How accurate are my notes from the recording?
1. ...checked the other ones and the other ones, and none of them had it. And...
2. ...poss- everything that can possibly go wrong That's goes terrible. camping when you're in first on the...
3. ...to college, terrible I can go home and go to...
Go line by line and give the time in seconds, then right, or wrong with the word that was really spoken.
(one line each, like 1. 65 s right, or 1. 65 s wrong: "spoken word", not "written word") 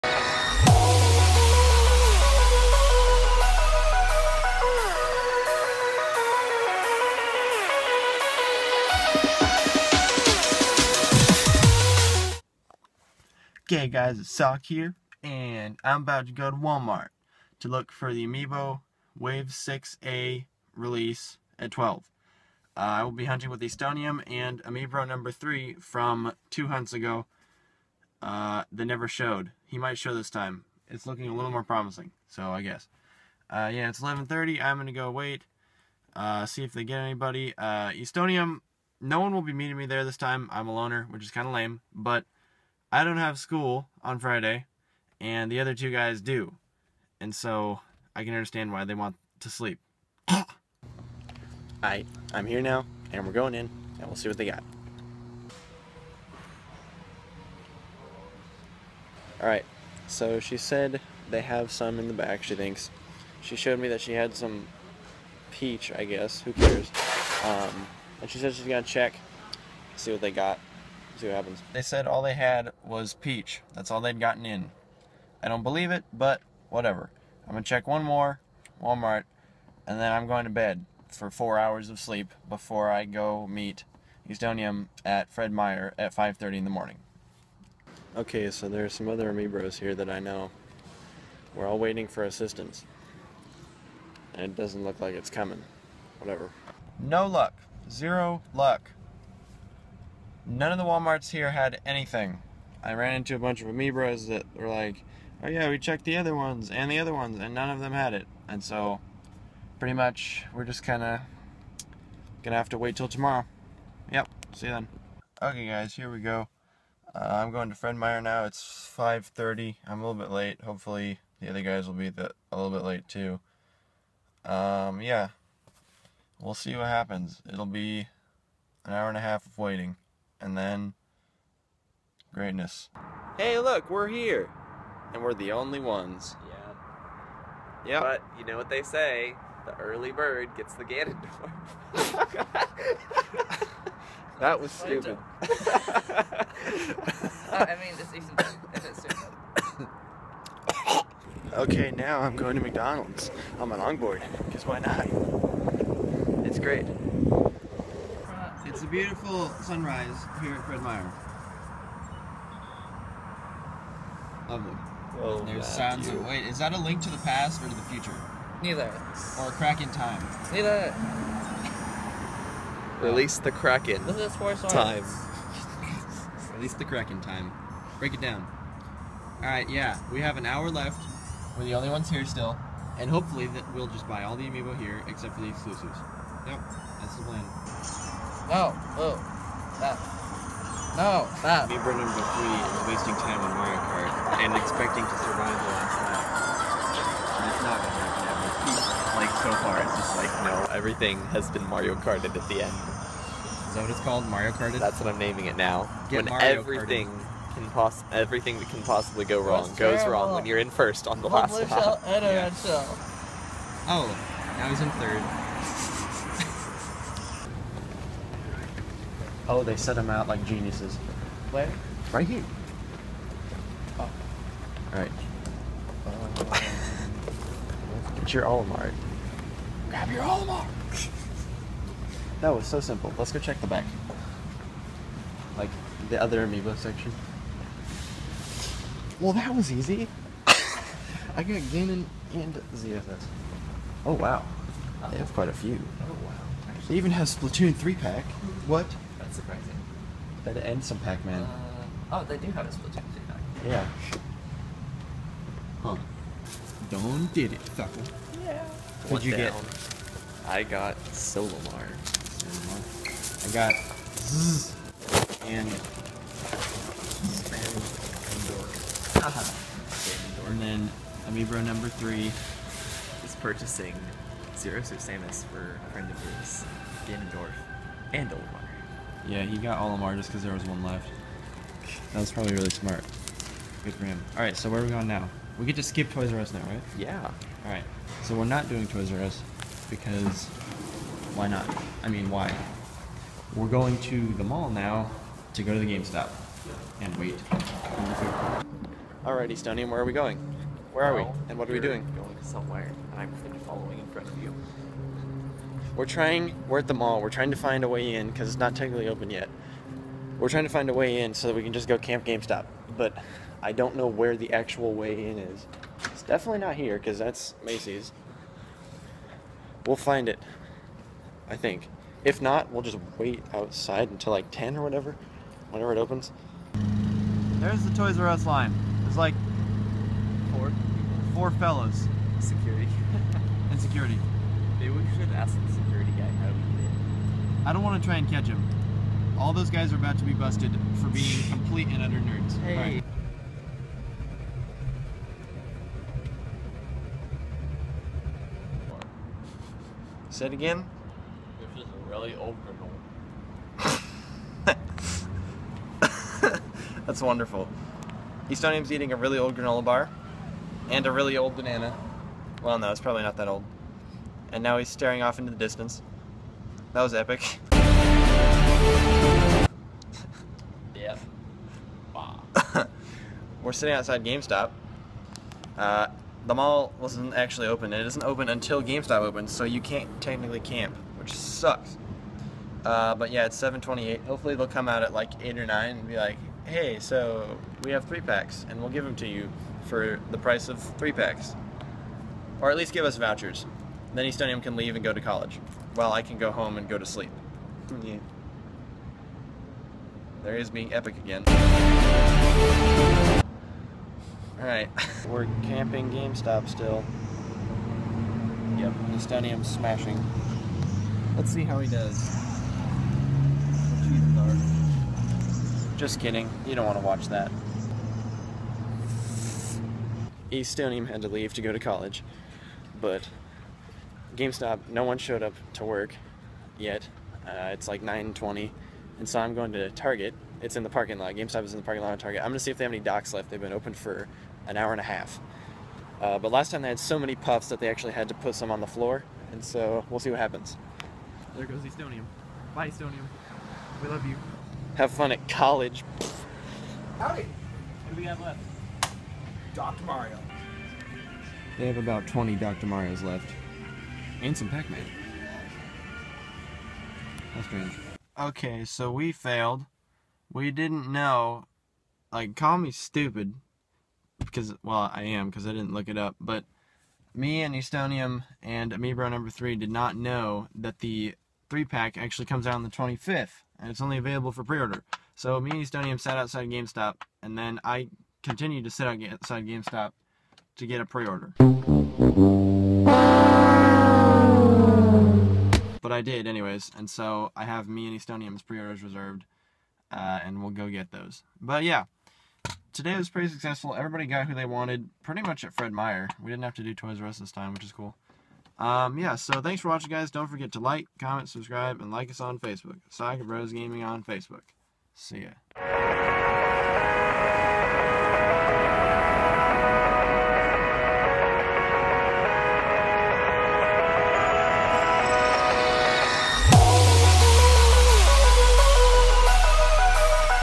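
1. 105 s right
2. 207 s wrong: "wrong", not "camping"
3. 395 s wrong: "while", not "terrible".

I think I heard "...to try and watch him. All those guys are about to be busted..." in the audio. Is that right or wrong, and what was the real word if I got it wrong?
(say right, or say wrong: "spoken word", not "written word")
wrong: "catch", not "watch".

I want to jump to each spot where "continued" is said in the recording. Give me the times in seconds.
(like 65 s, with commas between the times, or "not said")
478 s.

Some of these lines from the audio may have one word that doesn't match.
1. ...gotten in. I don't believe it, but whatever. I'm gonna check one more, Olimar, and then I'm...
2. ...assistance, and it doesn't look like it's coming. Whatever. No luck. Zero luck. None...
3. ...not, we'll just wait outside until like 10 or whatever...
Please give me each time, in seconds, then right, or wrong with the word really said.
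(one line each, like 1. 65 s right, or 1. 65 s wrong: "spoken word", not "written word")
1. 74 s wrong: "Walmart", not "Olimar"
2. 92 s right
3. 322 s right.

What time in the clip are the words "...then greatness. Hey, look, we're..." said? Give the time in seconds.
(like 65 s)
130 s.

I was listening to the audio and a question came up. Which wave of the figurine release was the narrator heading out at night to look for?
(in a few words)
Wave 6A.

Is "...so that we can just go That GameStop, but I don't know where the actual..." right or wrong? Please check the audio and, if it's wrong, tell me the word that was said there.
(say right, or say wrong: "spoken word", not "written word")
wrong: "Camp", not "That".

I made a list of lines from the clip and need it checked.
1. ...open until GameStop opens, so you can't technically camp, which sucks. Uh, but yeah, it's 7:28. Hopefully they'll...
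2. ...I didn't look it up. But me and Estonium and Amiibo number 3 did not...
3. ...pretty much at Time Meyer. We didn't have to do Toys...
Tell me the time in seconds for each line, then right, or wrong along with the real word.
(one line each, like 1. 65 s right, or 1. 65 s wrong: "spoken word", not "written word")
1. 378 s right
2. 465 s right
3. 495 s wrong: "Fred", not "Time".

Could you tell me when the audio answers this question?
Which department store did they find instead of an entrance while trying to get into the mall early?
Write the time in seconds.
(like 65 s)
317 s.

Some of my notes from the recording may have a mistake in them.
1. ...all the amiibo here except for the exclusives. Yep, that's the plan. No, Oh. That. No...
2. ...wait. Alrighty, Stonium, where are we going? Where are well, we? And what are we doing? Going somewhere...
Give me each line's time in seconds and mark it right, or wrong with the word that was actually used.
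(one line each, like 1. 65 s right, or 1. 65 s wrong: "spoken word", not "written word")
1. 184 s right
2. 297 s right.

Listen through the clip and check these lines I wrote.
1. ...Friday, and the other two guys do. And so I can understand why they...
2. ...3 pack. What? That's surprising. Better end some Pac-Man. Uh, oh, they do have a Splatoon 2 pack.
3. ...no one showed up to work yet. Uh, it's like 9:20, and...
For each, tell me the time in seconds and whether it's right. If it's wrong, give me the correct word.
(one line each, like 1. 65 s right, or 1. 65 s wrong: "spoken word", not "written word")
1. 44 s right
2. 247 s right
3. 424 s right.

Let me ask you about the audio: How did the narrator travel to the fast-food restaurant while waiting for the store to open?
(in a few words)
Longboard.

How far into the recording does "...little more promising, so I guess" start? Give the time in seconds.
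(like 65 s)
31 s.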